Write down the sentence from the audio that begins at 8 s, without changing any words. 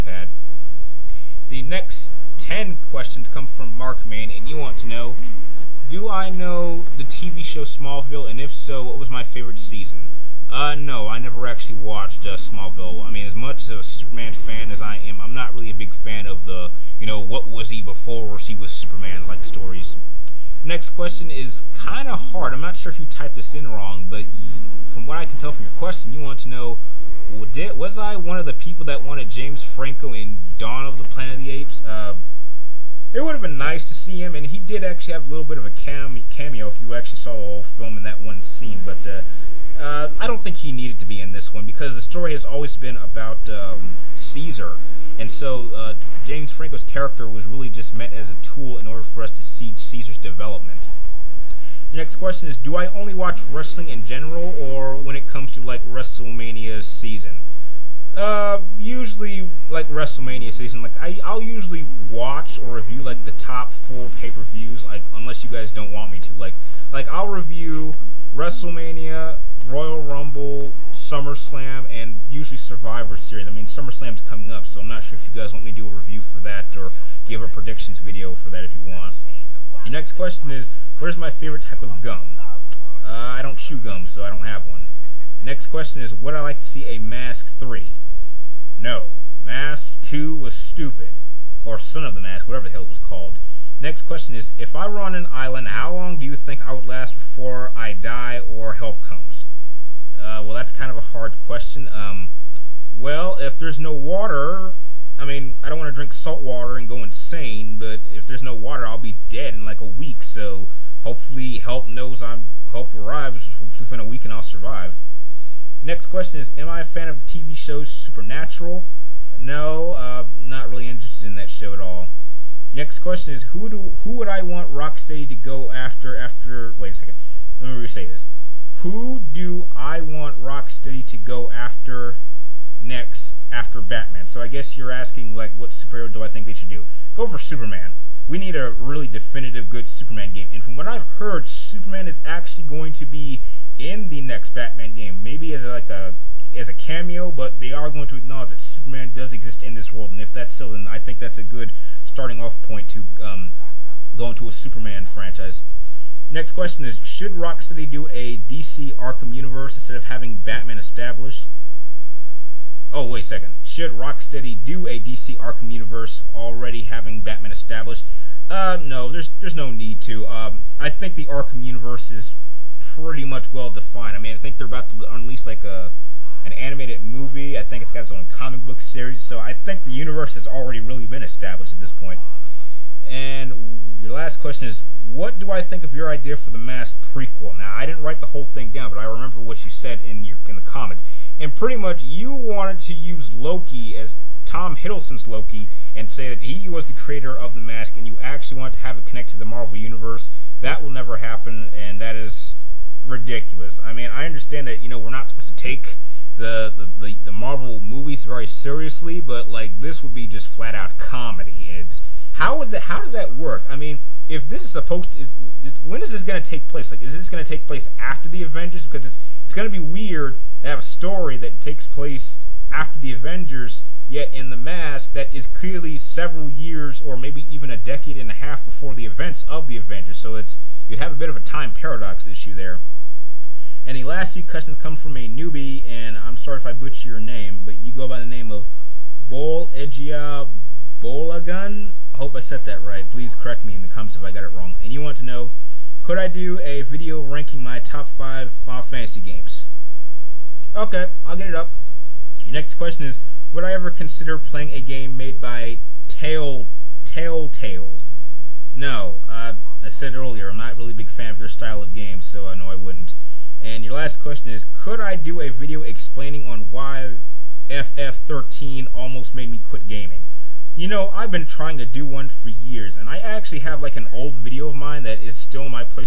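And if so, what was my favorite season?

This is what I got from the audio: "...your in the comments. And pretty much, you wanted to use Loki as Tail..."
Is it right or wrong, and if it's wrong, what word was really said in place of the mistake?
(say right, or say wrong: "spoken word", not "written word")
wrong: "Tom", not "Tail".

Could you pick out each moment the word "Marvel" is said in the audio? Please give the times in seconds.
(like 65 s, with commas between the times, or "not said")
199 s, 207 s.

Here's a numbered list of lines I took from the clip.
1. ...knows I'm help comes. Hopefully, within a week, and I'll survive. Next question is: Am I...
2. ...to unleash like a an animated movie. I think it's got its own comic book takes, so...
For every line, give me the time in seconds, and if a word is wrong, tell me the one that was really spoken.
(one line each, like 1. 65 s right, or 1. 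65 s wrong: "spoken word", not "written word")
1. 111 s wrong: "arrives", not "comes"
2. 174 s wrong: "series", not "takes".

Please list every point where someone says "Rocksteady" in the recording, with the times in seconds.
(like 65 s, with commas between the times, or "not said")
124 s, 130 s, 157 s, 163 s.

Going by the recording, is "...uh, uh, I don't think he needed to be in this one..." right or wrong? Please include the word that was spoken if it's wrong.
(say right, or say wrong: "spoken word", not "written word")
right.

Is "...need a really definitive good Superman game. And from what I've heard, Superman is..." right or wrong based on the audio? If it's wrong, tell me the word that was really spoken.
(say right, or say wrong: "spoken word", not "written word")
right.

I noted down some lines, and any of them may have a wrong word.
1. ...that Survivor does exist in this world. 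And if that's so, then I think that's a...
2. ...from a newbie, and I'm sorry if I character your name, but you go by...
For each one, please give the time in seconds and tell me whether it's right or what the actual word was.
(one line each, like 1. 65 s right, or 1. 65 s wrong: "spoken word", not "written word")
1. 148 s wrong: "Superman", not "Survivor"
2. 234 s wrong: "butcher", not "character".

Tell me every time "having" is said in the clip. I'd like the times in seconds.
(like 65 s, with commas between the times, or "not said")
160 s, 166 s.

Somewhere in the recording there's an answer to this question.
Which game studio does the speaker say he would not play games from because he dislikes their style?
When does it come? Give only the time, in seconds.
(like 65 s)
257 s.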